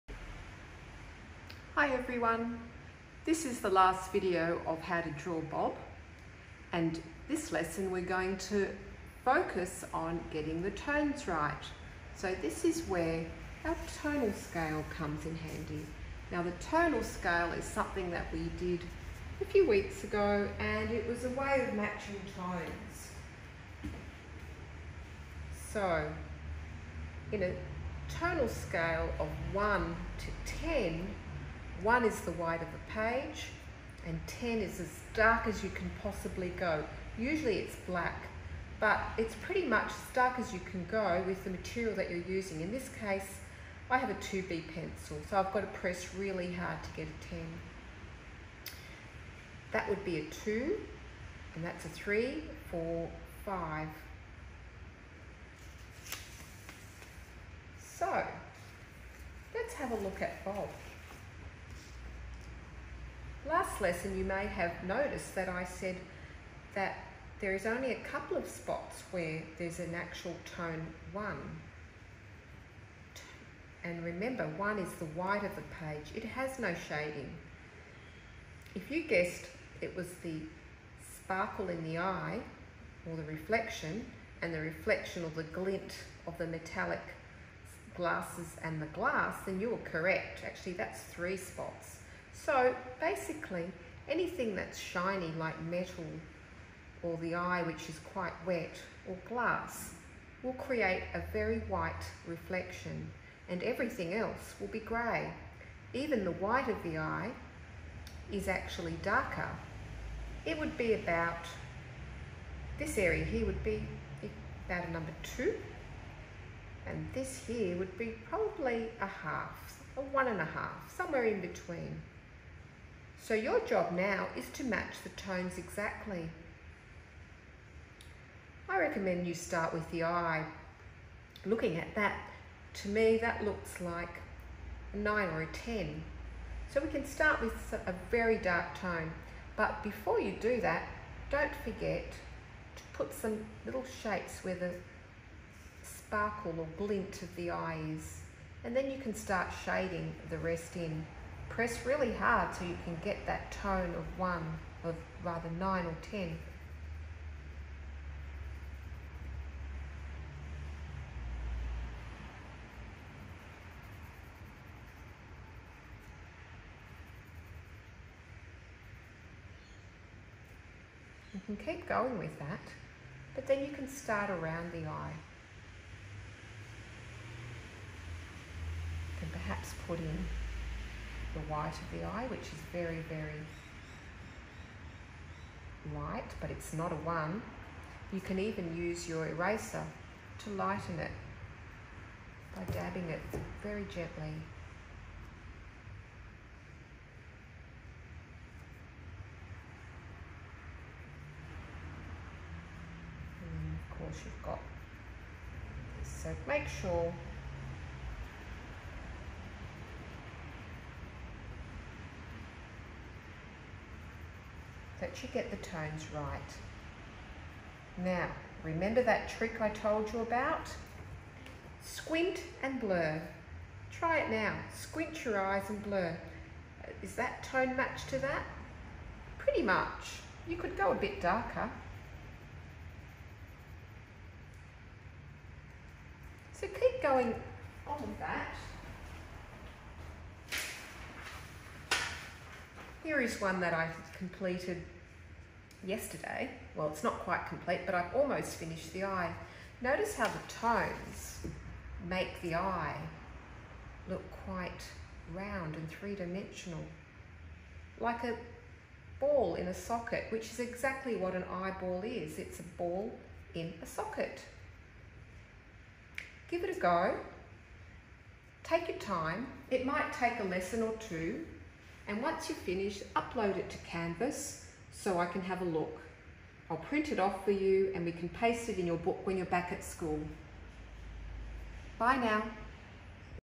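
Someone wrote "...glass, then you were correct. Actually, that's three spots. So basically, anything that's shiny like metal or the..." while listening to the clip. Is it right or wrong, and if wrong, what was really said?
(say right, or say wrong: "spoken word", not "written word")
right.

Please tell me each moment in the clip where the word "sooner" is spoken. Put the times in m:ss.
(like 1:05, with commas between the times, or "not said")
not said.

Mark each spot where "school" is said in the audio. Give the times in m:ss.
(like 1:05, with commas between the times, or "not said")
4:39.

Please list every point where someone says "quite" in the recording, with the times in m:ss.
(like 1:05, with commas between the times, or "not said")
1:38, 4:07, 4:14.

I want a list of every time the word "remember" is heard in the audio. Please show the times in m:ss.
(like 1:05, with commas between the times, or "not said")
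1:14, 3:38.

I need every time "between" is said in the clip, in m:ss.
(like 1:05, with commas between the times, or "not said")
2:01.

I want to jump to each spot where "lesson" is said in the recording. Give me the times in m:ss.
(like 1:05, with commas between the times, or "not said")
0:07, 1:03, 4:30.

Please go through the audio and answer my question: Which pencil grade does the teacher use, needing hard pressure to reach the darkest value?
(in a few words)
2B.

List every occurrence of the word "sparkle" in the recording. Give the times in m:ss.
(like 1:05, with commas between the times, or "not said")
1:21, 2:25.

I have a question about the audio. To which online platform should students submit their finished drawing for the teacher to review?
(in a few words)
Canvas.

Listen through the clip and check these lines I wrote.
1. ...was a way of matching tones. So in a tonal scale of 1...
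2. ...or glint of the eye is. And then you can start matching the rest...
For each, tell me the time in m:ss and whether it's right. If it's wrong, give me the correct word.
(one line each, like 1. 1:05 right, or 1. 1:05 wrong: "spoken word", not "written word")
1. 0:21 right
2. 2:26 wrong: "shading", not "matching".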